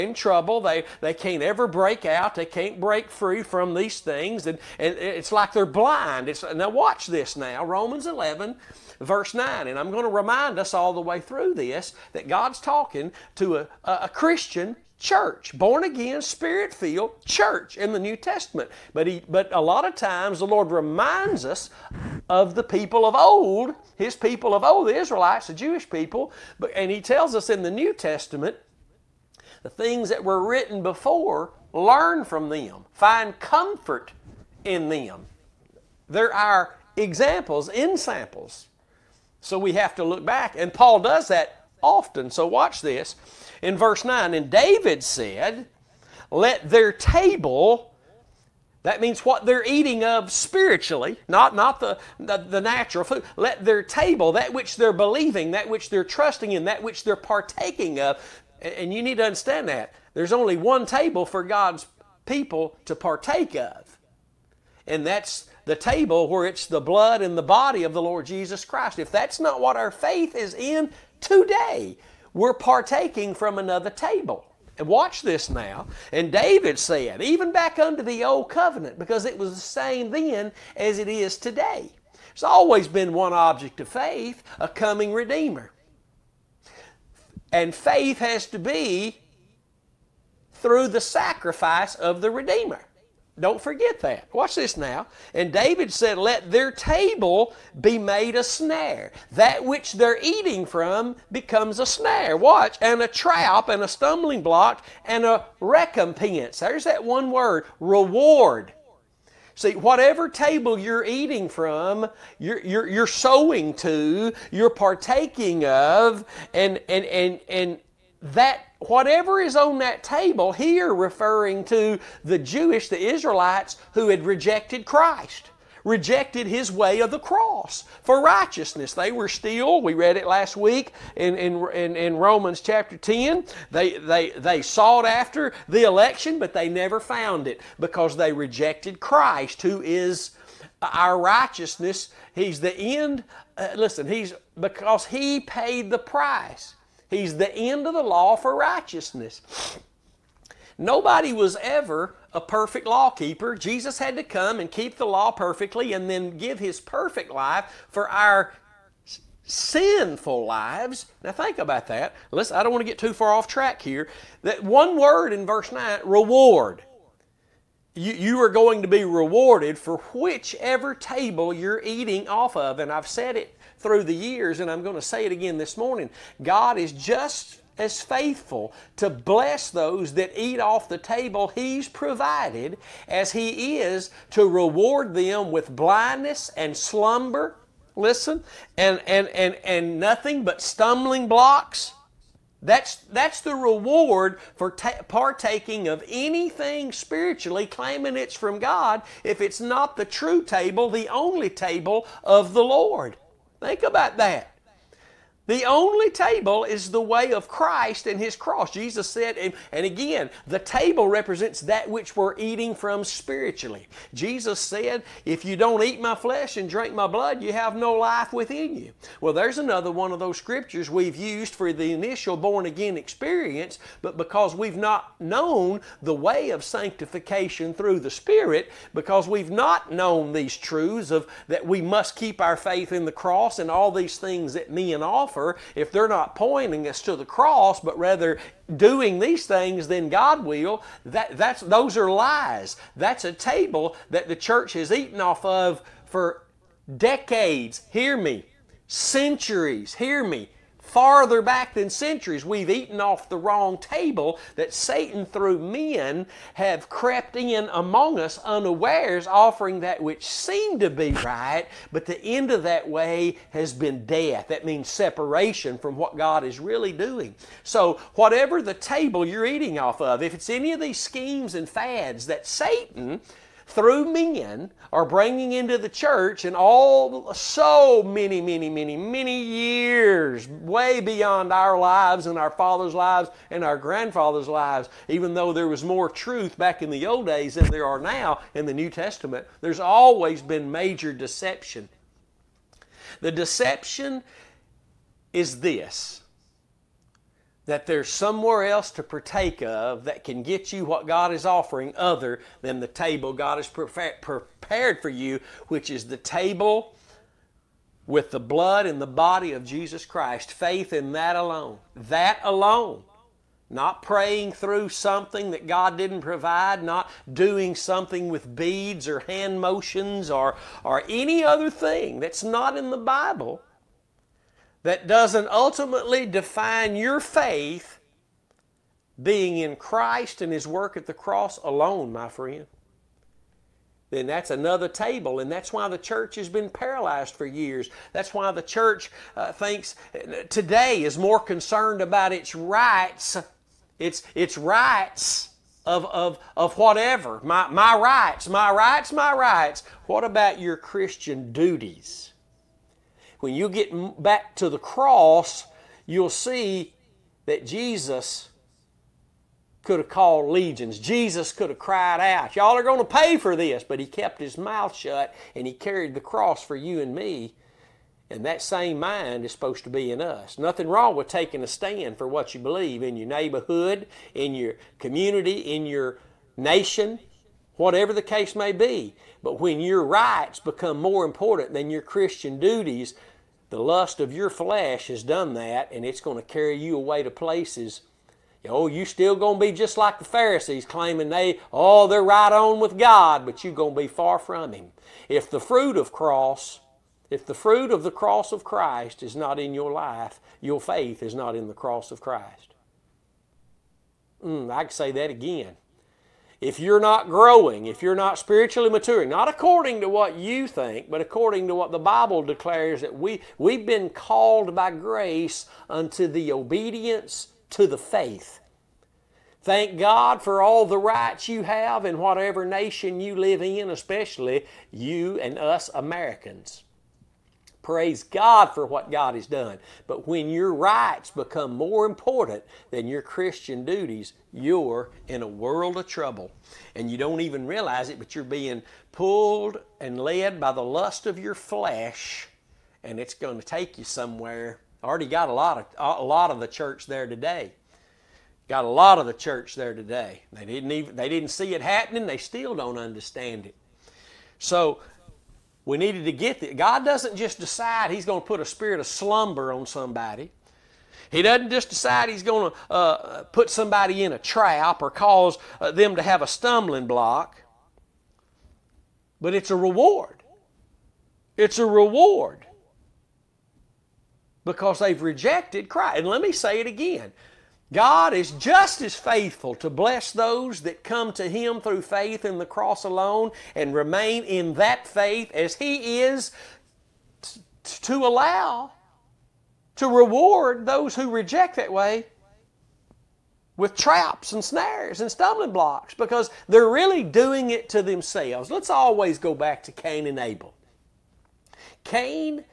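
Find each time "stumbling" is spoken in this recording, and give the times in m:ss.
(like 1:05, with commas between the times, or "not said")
1:43, 3:10, 7:46, 8:15.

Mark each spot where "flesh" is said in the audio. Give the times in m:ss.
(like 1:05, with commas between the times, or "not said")
3:36, 6:24, 7:21.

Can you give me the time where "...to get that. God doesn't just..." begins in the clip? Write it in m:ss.
7:36.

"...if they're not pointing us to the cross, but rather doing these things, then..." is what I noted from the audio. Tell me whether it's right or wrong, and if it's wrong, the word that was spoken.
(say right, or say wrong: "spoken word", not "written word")
right.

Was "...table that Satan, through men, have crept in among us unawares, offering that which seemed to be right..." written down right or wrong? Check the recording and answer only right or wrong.
right.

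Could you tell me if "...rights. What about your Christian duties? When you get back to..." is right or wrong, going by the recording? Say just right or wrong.
right.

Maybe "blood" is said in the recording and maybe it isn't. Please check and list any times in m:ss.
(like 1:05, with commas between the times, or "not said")
1:06, 3:37, 5:08.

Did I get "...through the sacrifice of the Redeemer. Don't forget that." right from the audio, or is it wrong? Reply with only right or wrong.
right.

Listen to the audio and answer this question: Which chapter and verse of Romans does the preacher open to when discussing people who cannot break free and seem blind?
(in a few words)
Romans 11:9.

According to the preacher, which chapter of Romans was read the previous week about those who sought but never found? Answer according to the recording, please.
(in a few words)
Chapter 10.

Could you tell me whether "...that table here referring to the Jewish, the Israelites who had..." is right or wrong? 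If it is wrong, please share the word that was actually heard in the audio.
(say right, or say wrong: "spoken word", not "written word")
right.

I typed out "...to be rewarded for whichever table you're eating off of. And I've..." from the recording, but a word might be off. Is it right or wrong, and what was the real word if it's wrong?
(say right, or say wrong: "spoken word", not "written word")
right.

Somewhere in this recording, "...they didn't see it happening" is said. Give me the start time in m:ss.
7:31.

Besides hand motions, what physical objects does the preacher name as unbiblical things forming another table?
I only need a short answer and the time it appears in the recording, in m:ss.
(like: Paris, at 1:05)
beads, at 5:18.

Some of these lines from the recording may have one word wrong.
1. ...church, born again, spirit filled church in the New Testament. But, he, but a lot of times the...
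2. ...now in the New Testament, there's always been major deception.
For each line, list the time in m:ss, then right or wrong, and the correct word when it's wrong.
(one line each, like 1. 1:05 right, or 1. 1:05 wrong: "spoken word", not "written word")
1. 0:14 right
2. 4:47 right.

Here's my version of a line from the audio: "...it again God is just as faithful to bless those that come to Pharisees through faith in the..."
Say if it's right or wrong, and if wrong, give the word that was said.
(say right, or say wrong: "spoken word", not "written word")
wrong: "Him", not "Pharisees".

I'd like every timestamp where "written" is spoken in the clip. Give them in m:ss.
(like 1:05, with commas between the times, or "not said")
0:30.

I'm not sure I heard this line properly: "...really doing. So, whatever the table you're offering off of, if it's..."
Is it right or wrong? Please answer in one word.
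wrong.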